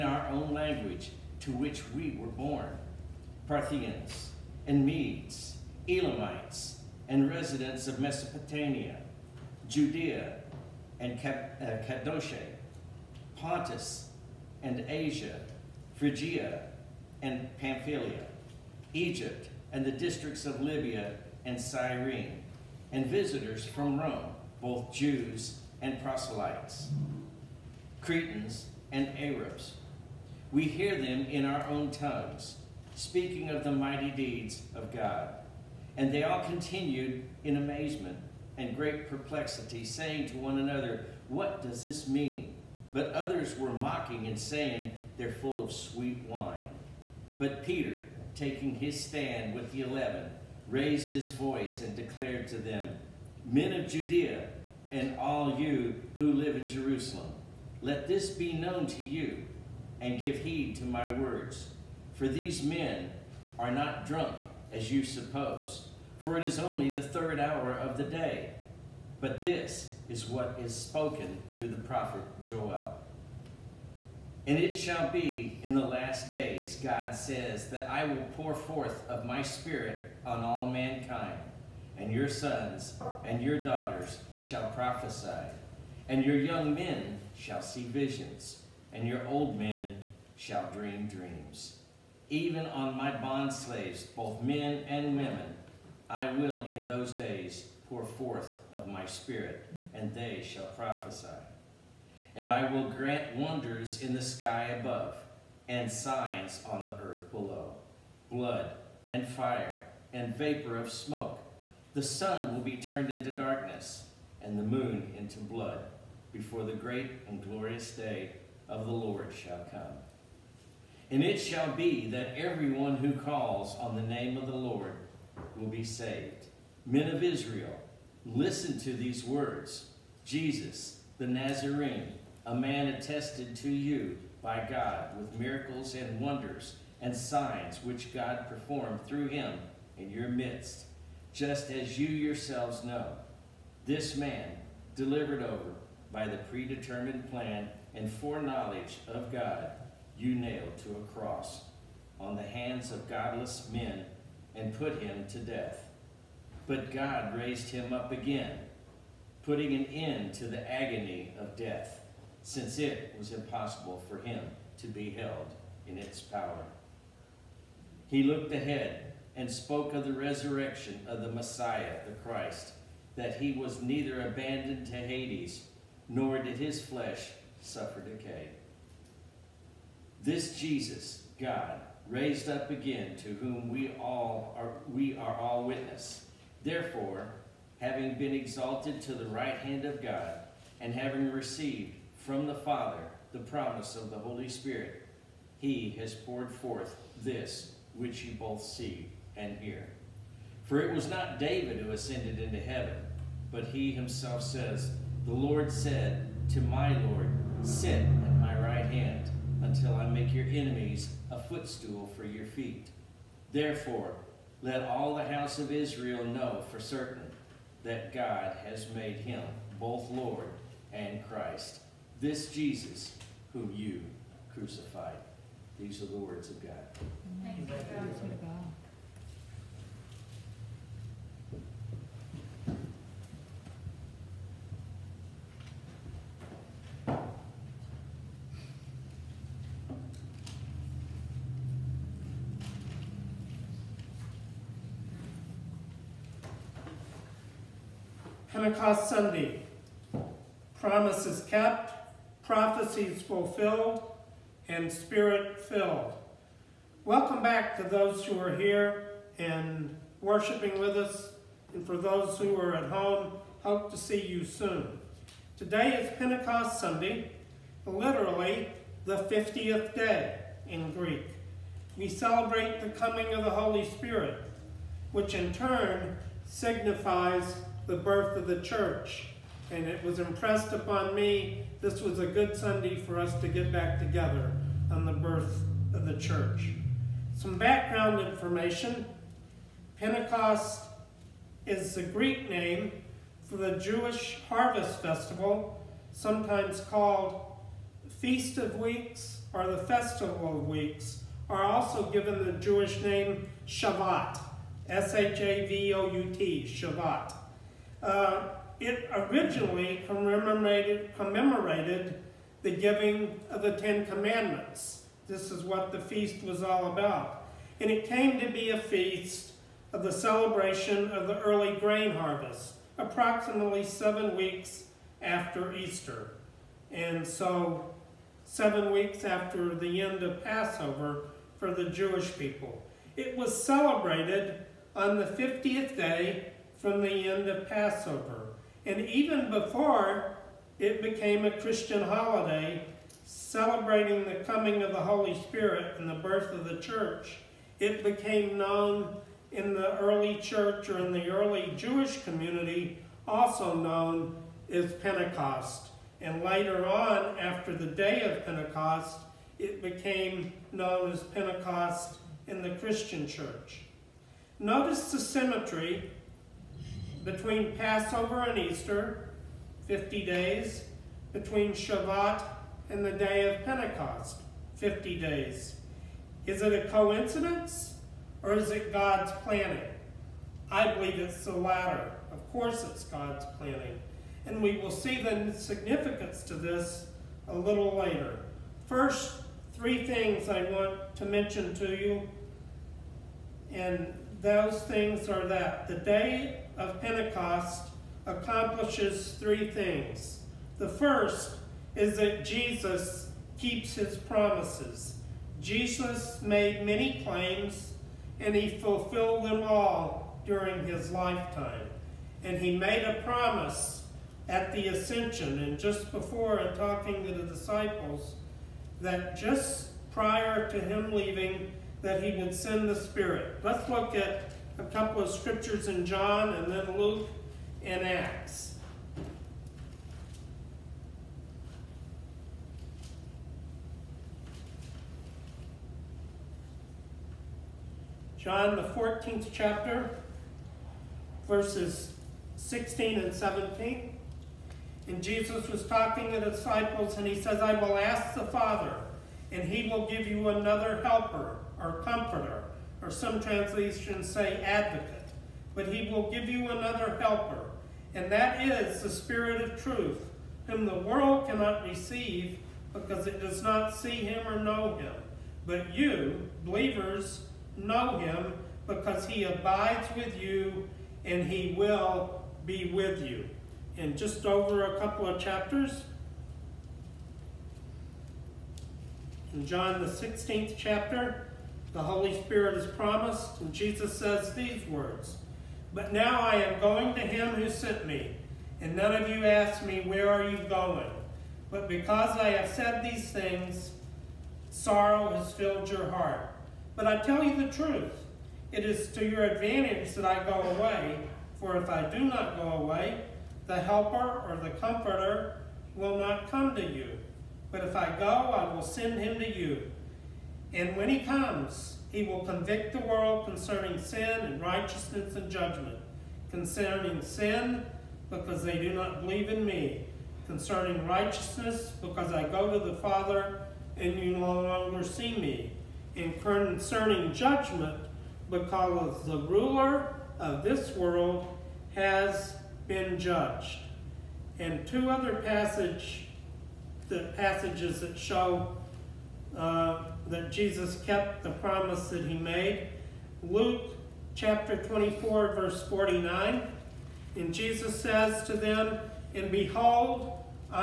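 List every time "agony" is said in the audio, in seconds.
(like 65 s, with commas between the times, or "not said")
160 s.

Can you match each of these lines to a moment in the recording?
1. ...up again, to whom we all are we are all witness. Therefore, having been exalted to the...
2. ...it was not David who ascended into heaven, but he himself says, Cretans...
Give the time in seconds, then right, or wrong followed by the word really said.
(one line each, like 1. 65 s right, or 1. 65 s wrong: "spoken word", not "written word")
1. 182 s right
2. 200 s wrong: "The", not "Cretans".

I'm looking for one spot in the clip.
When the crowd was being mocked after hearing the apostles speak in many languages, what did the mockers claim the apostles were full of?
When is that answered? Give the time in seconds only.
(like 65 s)
45 s.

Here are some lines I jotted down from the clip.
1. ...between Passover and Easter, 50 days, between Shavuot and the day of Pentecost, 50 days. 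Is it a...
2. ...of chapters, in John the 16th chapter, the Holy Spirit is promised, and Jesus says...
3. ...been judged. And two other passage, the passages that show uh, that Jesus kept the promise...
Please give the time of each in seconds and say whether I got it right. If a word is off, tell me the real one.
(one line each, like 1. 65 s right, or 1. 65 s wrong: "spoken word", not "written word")
1. 367 s right
2. 475 s right
3. 532 s right.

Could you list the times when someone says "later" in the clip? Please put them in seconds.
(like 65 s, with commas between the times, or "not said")
356 s, 387 s.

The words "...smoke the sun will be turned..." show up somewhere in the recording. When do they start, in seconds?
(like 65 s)
110 s.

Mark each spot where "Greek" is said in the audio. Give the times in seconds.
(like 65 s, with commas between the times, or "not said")
270 s, 292 s.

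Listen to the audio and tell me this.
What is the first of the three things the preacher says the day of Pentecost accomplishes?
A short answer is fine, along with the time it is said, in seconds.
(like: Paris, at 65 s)
Jesus keeps his promises, at 402 s.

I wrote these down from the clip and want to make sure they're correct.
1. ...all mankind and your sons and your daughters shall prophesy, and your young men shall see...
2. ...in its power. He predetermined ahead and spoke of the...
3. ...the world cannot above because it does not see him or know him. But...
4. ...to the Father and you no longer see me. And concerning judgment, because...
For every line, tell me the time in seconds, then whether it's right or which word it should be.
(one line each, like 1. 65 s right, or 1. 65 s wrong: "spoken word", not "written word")
1. 80 s right
2. 165 s wrong: "looked", not "predetermined"
3. 460 s wrong: "receive", not "above"
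4. 522 s right.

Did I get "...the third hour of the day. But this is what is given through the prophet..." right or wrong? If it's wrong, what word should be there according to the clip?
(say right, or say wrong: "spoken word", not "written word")
wrong: "spoken", not "given".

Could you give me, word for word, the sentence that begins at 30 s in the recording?
We hear them in our own tongues, speaking of the mighty deeds of God.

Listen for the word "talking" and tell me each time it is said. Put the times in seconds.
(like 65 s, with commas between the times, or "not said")
416 s, 445 s.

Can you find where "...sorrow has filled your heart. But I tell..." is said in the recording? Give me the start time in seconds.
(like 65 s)
494 s.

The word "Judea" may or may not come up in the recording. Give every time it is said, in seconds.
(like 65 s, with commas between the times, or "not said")
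9 s, 53 s.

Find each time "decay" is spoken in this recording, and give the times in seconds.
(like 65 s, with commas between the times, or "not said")
177 s.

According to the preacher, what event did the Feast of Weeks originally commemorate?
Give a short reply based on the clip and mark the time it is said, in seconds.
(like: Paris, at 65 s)
Giving of the Ten Commandments, at 312 s.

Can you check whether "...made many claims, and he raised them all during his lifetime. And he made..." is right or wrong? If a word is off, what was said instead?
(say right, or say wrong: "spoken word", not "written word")
wrong: "fulfilled", not "raised".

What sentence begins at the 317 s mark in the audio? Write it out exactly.
And it came to be a feast of the celebration of the early grain harvest, approximately seven weeks after Easter.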